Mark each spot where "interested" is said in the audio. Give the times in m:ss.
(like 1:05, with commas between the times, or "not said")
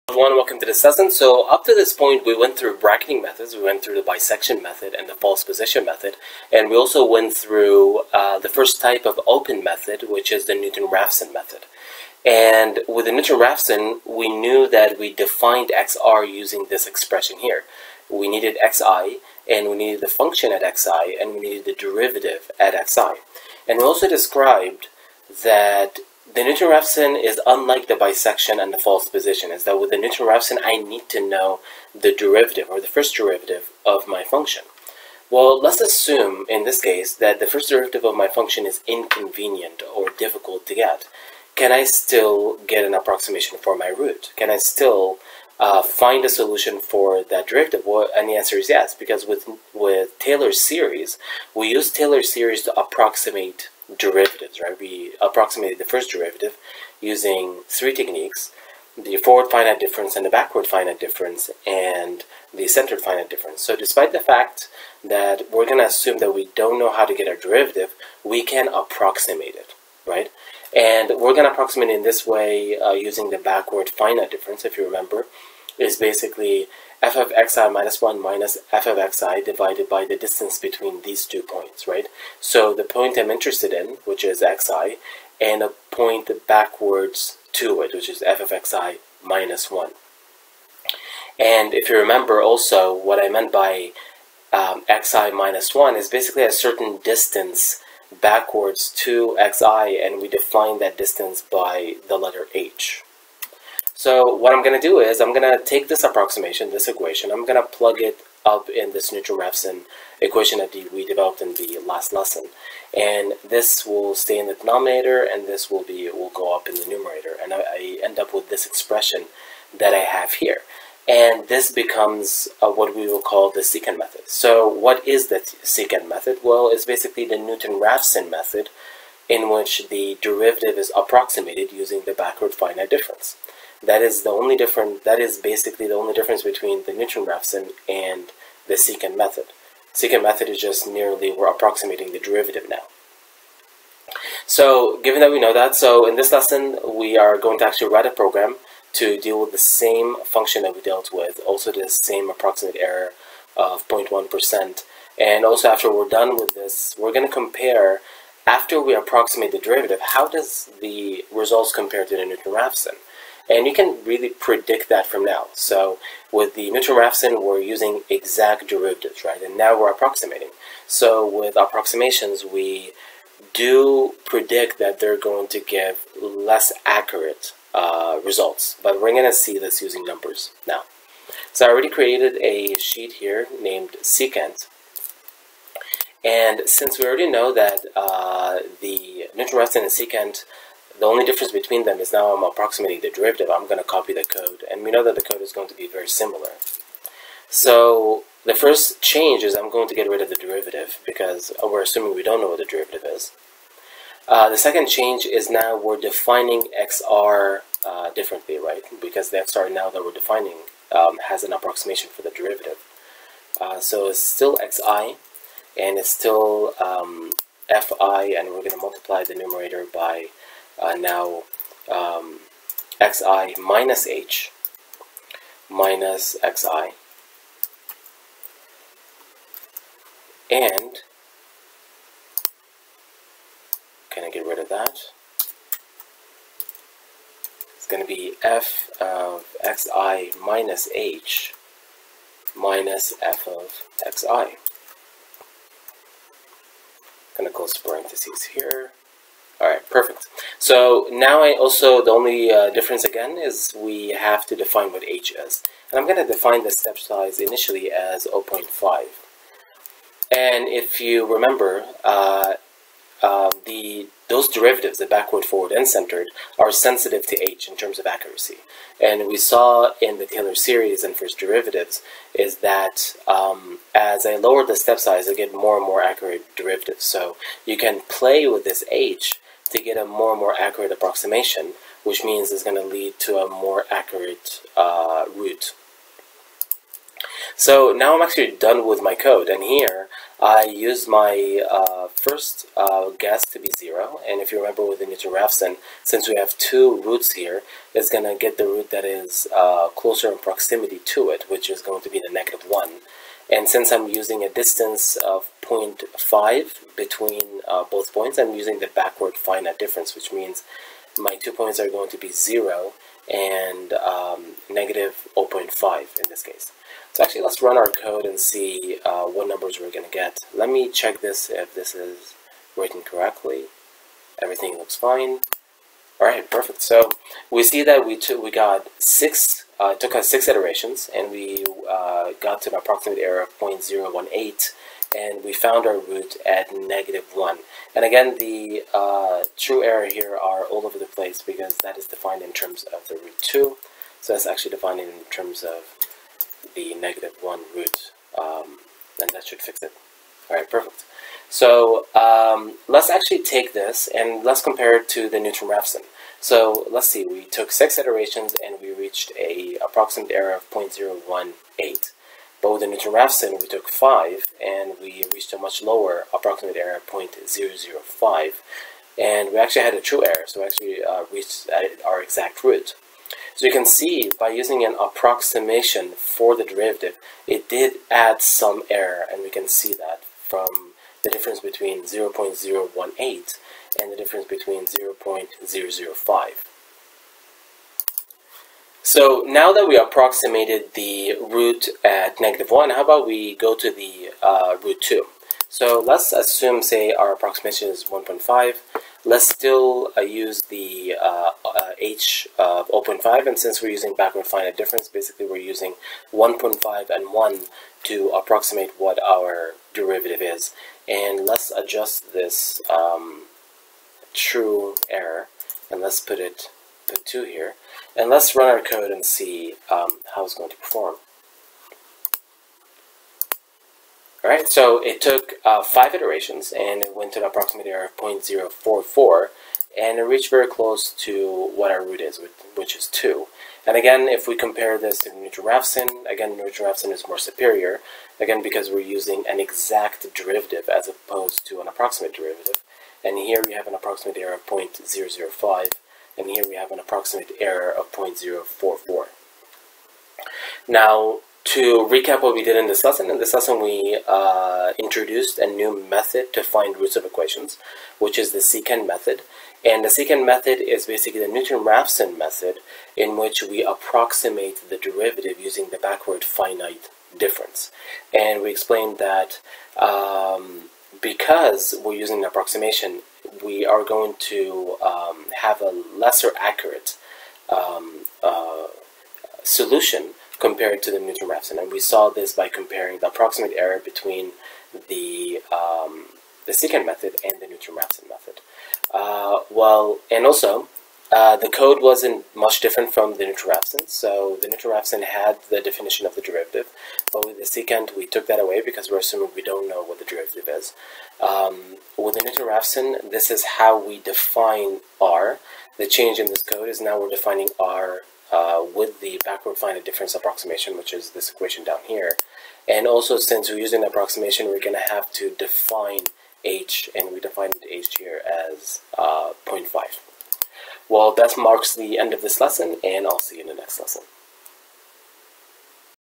1:23.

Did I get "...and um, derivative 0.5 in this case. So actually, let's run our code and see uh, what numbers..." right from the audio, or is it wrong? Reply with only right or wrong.
wrong.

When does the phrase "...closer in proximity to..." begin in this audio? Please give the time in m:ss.
4:59.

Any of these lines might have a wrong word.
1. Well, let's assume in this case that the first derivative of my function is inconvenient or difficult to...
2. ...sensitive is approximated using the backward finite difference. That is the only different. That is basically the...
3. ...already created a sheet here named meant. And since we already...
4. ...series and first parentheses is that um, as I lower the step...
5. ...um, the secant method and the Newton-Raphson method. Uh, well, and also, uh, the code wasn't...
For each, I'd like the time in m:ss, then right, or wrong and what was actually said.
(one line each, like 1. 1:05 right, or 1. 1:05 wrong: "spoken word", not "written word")
1. 0:35 right
2. 2:10 wrong: "derivative", not "sensitive"
3. 3:01 wrong: "secant", not "meant"
4. 4:30 wrong: "derivatives", not "parentheses"
5. 8:05 right.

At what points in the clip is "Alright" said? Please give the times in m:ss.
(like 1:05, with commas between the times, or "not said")
7:04.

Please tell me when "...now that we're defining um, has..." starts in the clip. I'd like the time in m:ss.
3:29.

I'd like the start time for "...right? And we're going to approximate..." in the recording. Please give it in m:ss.
1:10.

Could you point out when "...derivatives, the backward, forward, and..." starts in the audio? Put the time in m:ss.
4:24.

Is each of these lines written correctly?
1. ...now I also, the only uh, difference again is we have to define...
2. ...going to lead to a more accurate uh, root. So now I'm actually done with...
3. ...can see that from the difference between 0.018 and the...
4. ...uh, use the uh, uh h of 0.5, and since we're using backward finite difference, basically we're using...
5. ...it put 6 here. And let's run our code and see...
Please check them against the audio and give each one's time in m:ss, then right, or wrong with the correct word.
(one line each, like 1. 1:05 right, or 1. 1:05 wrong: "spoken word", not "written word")
1. 4:11 right
2. 4:42 right
3. 6:19 right
4. 6:40 right
5. 6:56 wrong: "2", not "6".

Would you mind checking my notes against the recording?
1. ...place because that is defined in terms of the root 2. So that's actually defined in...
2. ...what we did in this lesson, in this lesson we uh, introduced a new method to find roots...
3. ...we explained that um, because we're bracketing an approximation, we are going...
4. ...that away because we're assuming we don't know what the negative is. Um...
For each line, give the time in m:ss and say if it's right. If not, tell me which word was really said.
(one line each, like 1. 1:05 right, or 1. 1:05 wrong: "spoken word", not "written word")
1. 5:41 right
2. 7:32 right
3. 7:48 wrong: "using", not "bracketing"
4. 8:18 wrong: "derivative", not "negative".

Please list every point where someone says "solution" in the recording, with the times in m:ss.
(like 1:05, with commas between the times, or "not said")
0:46, 7:59.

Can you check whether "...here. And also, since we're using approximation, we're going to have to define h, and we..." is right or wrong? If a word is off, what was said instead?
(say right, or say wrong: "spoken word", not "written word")
right.